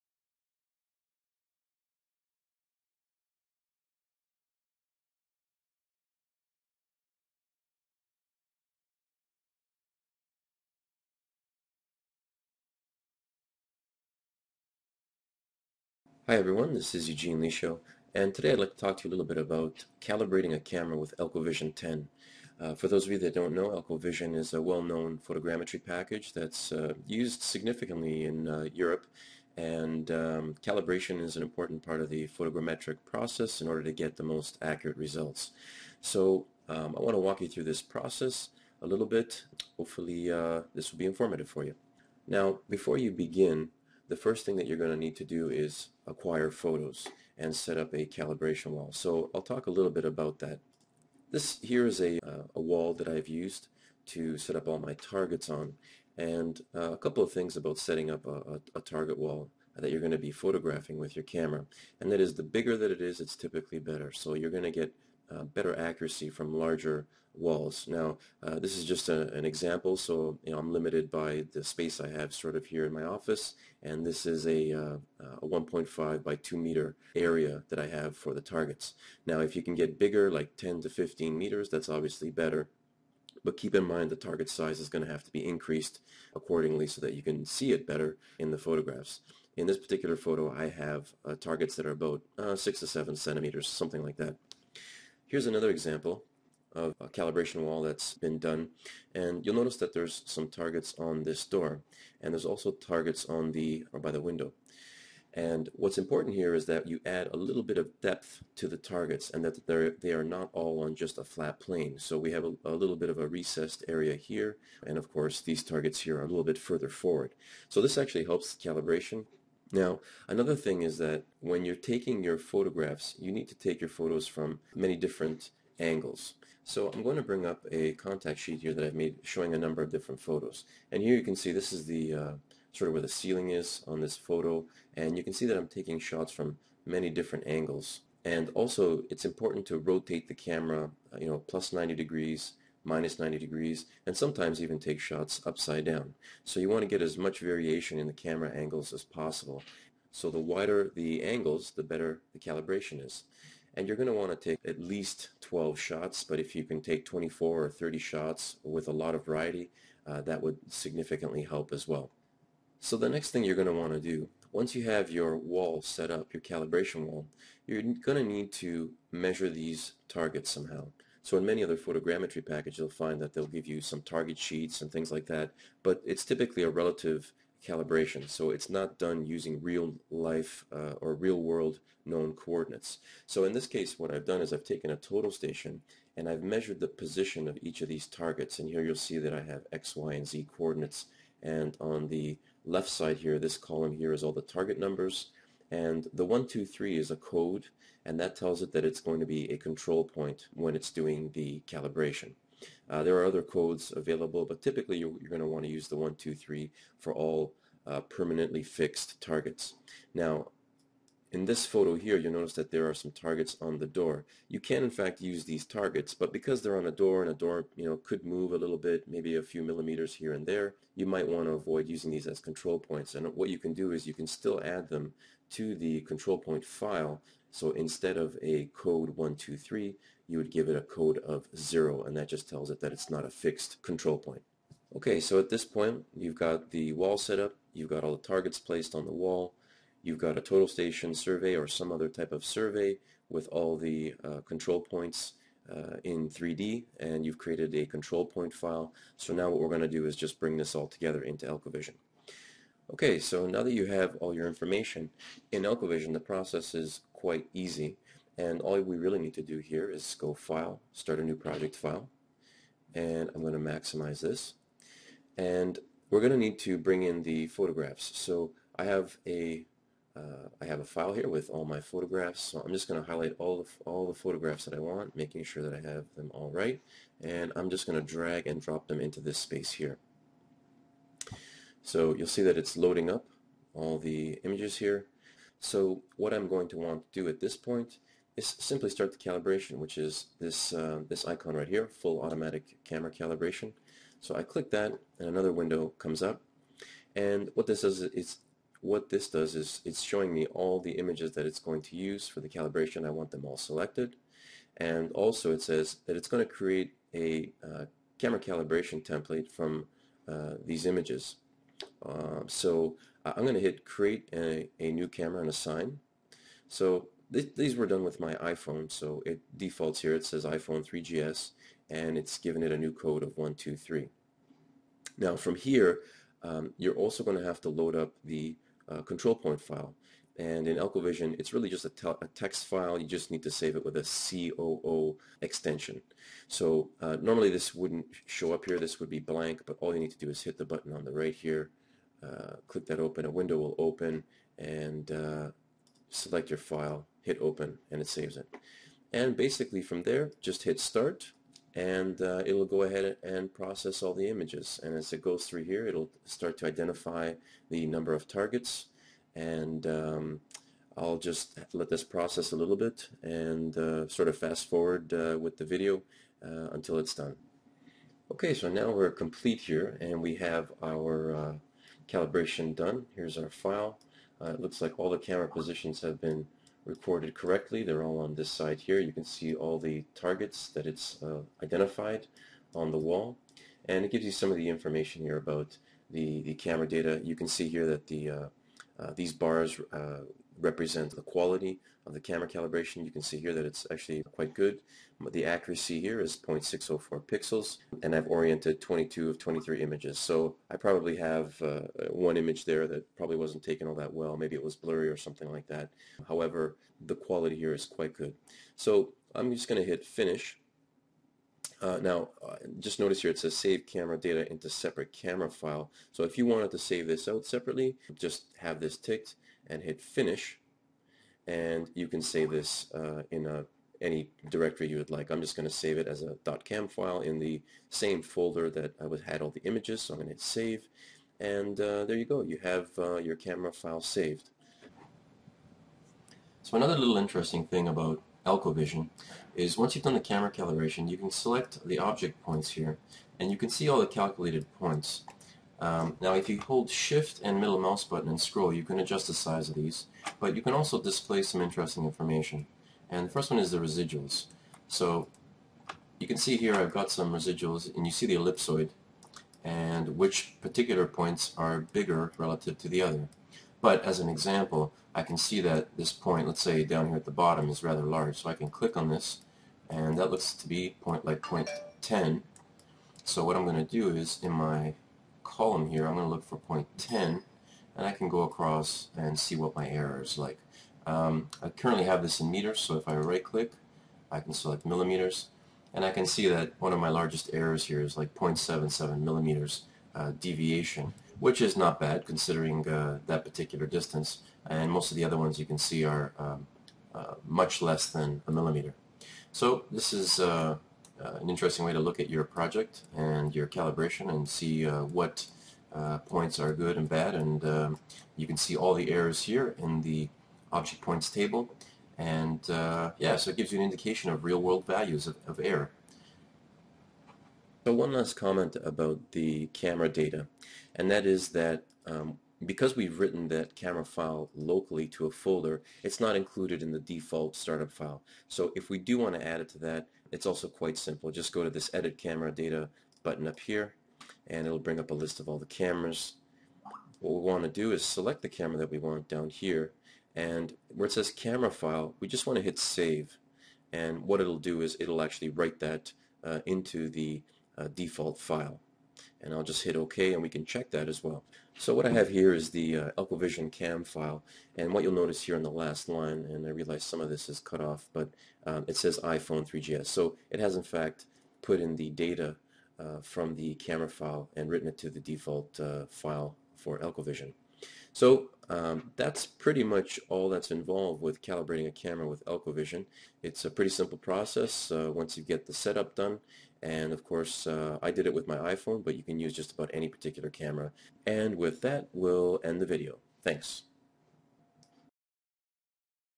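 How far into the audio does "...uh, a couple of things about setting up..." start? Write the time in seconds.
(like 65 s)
56 s.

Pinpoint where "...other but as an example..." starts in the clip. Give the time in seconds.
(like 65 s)
463 s.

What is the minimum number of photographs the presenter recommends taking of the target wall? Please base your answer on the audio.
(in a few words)
12.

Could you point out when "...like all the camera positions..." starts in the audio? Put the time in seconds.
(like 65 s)
374 s.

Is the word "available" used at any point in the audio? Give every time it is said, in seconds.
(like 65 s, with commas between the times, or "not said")
203 s.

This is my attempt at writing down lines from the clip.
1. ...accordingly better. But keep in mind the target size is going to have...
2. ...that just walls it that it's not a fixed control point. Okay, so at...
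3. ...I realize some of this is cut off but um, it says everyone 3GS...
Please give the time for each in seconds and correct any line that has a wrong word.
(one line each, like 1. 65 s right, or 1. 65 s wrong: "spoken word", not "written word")
1. 81 s wrong: "obviously", not "accordingly"
2. 232 s wrong: "tells", not "walls"
3. 556 s wrong: "iPhone", not "everyone".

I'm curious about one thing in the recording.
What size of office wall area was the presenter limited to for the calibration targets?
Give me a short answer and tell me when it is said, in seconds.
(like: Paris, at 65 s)
1.5 by 2 meters, at 75 s.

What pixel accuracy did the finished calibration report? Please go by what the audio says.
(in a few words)
0.604 pixels.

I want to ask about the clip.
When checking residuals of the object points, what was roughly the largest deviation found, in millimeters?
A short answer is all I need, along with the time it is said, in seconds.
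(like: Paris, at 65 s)
0.77 millimeters, at 488 s.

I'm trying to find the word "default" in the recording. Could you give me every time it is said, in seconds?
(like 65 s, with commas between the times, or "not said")
319 s, 526 s, 547 s, 565 s.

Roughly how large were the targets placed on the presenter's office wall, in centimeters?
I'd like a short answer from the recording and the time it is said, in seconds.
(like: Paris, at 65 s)
6 to 7 centimeters, at 92 s.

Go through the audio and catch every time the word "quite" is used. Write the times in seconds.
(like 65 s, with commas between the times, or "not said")
257 s, 394 s, 407 s, 530 s.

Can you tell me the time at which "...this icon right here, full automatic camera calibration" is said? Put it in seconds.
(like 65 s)
291 s.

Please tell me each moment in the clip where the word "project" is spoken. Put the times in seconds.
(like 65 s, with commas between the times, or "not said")
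261 s, 502 s.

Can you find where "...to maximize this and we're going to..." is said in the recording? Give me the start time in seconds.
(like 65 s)
263 s.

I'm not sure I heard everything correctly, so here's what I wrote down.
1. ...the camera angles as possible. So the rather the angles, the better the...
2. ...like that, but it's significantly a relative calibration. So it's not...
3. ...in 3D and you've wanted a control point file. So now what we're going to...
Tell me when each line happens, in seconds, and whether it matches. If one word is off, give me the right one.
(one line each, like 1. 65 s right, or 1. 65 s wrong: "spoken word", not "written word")
1. 148 s wrong: "wider", not "rather"
2. 175 s wrong: "typically", not "significantly"
3. 246 s wrong: "created", not "wanted".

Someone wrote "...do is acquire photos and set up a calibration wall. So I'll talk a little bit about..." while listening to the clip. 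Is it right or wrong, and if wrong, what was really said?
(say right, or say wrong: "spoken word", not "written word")
right.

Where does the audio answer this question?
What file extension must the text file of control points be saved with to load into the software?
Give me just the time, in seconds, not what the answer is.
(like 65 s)
334 s.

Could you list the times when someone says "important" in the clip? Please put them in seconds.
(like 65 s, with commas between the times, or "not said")
31 s, 105 s, 139 s.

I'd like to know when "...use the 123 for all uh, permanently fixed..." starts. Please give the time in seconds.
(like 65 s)
205 s.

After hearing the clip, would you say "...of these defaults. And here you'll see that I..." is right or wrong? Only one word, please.
wrong.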